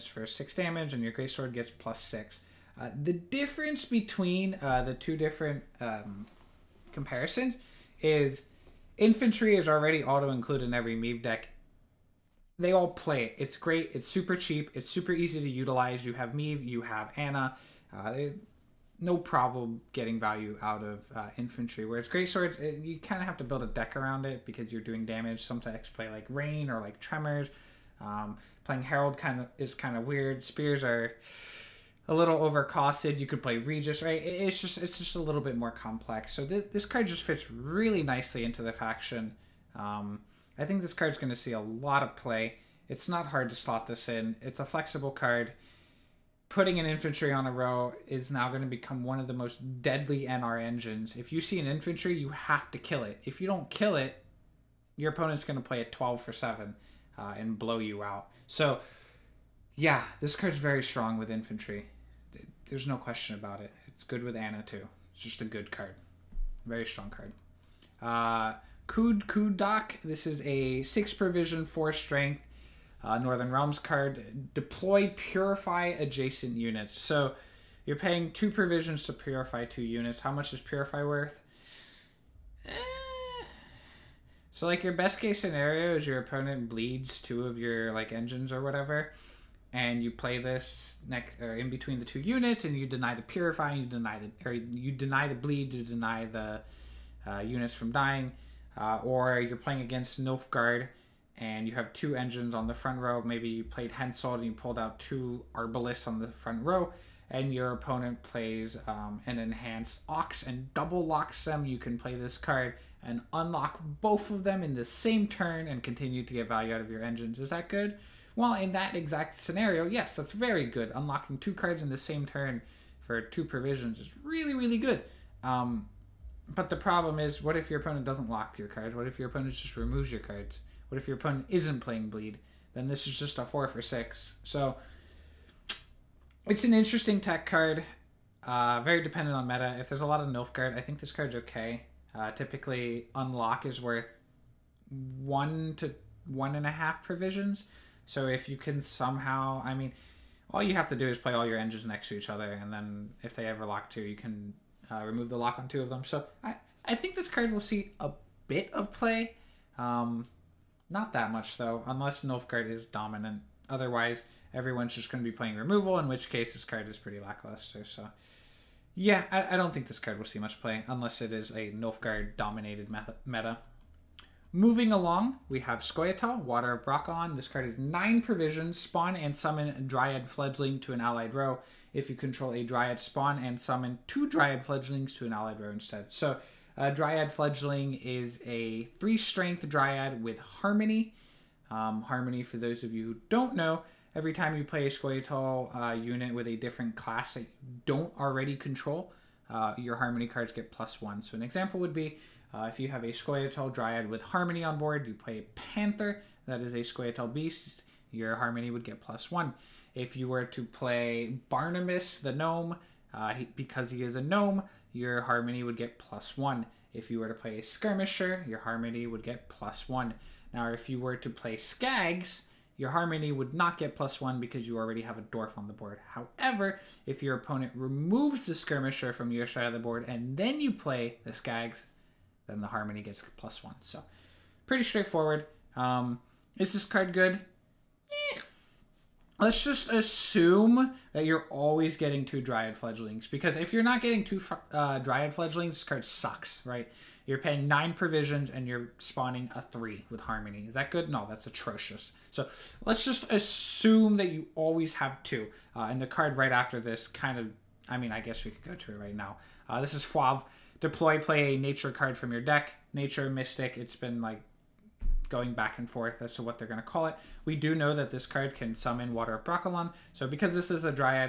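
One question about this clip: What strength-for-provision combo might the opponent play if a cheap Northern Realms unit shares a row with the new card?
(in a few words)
12 for 7.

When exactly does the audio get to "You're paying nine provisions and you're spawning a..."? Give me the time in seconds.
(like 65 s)
247 s.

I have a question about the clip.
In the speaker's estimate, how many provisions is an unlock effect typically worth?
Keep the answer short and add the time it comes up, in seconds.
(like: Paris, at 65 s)
1 to 1.5 provisions, at 145 s.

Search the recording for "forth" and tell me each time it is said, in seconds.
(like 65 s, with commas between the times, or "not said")
265 s.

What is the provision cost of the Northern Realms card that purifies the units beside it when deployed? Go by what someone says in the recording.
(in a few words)
6.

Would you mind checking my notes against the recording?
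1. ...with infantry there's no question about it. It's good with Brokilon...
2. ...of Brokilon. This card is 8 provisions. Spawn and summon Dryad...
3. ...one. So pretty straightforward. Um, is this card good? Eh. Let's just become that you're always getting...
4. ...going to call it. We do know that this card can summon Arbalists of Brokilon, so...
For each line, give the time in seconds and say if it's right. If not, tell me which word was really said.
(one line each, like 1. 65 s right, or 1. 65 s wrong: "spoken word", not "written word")
1. 61 s wrong: "Anna", not "Brokilon"
2. 176 s wrong: "9", not "8"
3. 233 s wrong: "assume", not "become"
4. 266 s wrong: "Water", not "Arbalists".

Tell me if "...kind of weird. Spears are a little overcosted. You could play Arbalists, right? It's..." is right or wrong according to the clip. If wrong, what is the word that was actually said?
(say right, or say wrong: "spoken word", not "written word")
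wrong: "Regis", not "Arbalists".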